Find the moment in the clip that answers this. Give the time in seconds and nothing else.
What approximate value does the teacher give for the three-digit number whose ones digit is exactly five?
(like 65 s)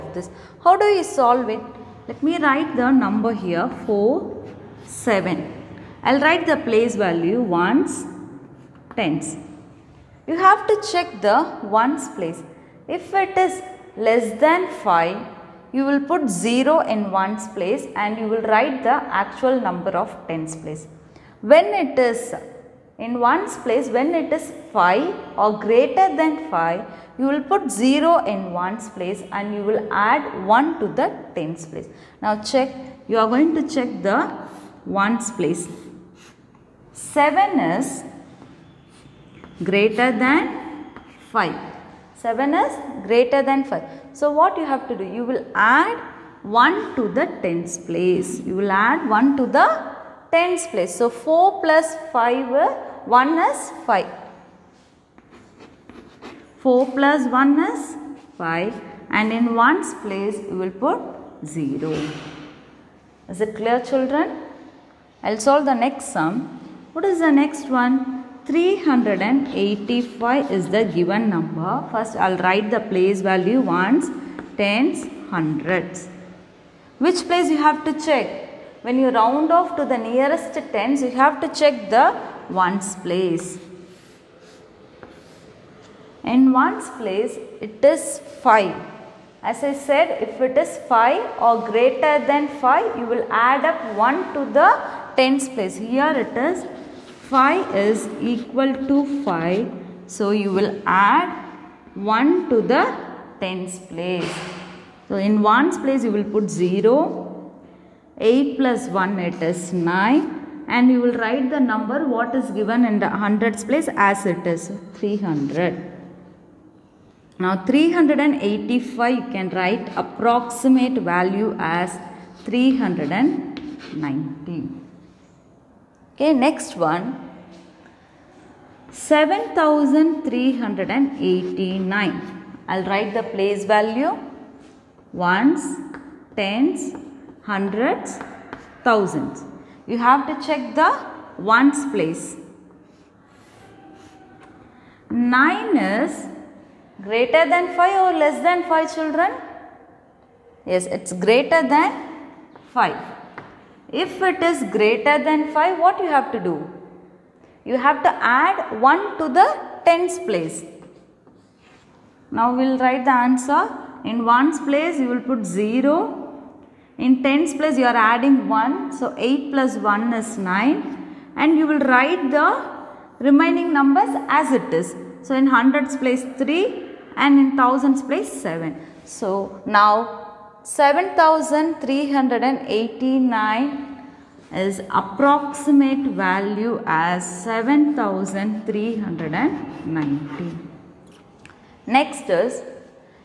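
122 s.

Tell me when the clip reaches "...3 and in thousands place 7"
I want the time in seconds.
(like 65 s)
176 s.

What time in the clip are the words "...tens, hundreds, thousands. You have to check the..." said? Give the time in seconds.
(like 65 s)
136 s.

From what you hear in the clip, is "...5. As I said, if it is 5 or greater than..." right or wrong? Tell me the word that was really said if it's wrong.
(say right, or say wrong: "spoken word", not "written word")
right.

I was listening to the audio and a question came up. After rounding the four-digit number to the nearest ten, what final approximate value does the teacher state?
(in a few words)
7390.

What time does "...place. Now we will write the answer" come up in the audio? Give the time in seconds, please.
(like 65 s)
160 s.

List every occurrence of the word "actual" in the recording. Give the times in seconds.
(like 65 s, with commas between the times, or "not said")
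18 s.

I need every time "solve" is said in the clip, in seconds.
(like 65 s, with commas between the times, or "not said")
1 s, 65 s.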